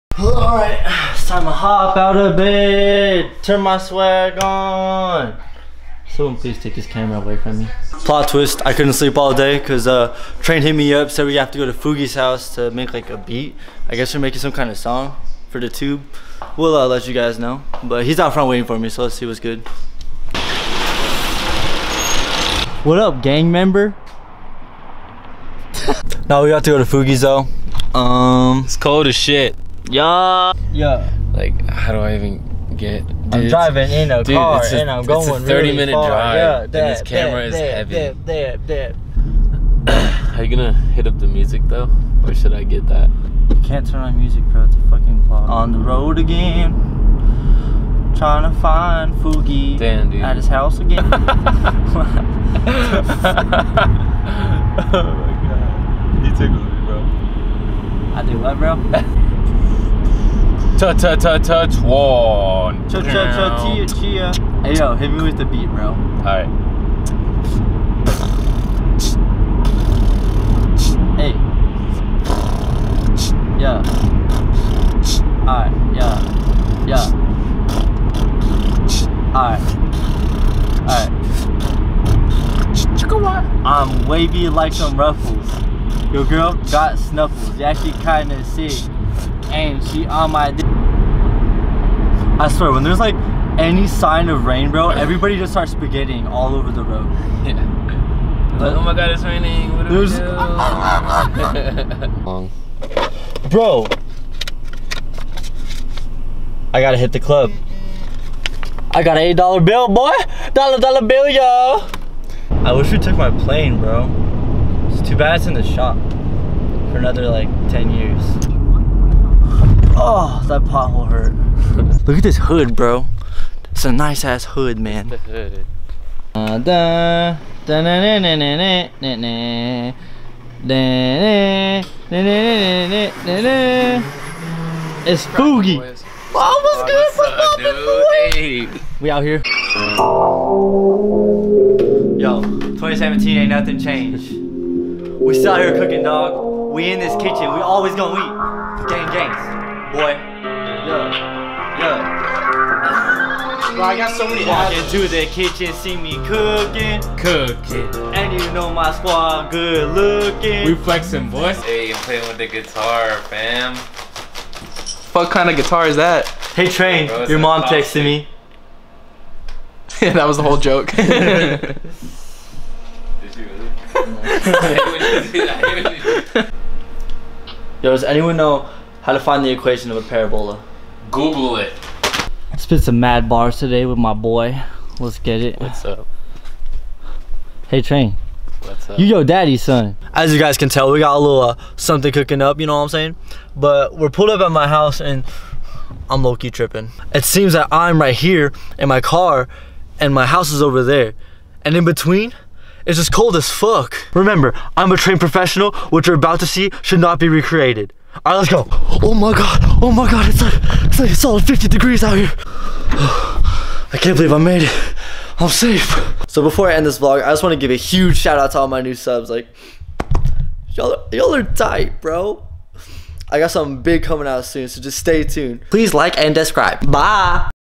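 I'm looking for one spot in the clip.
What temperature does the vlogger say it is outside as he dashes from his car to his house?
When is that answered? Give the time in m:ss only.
3:31.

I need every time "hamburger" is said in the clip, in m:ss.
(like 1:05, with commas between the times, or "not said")
not said.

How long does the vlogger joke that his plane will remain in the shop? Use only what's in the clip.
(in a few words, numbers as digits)
10 years.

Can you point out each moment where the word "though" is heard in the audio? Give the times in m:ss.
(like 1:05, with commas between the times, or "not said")
0:27, 0:41.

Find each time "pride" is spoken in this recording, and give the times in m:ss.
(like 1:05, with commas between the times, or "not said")
not said.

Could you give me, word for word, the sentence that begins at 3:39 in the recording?
Like, y'all y'all are tight, bro.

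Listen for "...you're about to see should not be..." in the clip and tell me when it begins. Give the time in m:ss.
3:26.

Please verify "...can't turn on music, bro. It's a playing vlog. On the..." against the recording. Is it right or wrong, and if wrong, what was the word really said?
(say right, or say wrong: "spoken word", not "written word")
wrong: "fucking", not "playing".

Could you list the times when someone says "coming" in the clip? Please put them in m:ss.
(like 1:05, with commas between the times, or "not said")
3:44.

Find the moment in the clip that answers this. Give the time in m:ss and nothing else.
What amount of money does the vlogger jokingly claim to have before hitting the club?
1:49.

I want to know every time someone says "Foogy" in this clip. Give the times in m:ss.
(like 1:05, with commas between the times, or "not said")
0:11, 0:26, 2:15.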